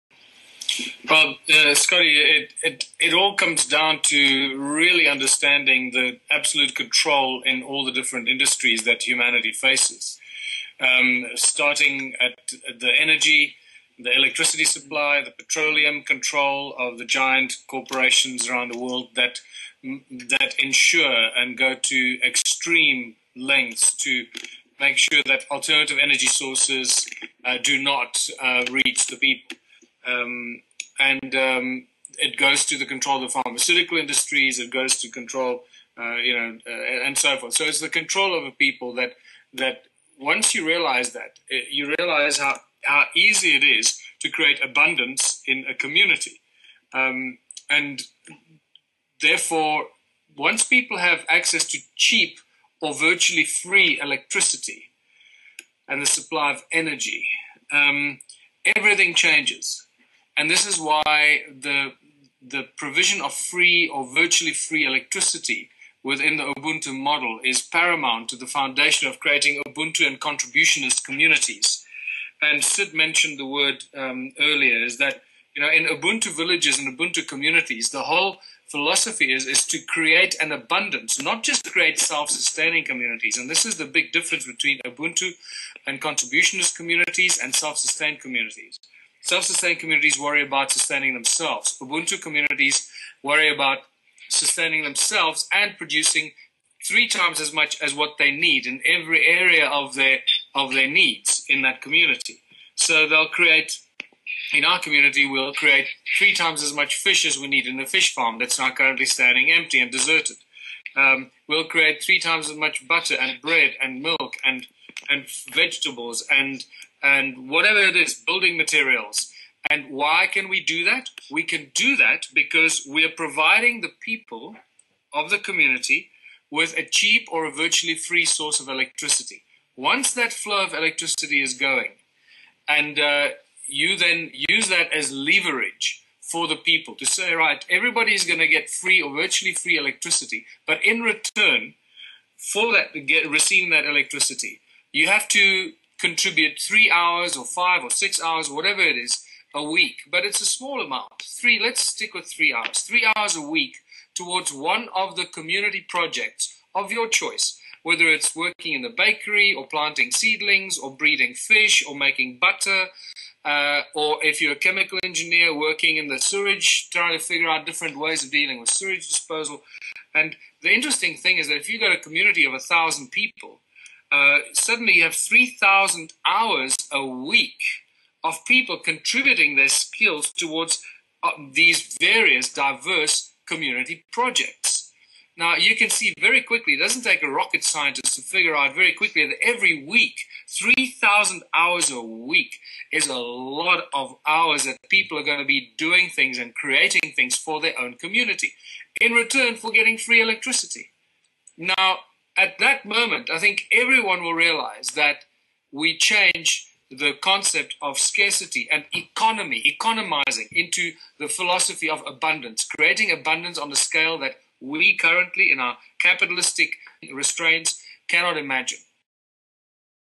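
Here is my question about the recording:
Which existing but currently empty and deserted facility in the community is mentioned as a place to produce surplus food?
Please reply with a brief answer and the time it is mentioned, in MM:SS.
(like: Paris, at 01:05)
fish farm, at 01:47.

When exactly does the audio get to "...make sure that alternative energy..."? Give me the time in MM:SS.
00:24.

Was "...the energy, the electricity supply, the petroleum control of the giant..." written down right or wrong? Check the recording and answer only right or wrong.
right.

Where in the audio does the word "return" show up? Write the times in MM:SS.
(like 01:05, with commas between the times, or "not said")
02:21, 03:19.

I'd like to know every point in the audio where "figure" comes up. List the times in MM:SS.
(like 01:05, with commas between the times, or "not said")
02:47, 03:08.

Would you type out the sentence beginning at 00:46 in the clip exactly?
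Um, and therefore, once people have access to cheap or virtually free electricity and the supply of energy, um, everything changes.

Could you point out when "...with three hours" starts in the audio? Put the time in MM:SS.
02:32.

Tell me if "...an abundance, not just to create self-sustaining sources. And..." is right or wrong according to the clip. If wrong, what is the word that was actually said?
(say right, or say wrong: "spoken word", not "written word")
wrong: "communities", not "sources".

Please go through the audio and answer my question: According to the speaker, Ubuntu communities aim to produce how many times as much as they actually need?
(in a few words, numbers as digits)
3 times.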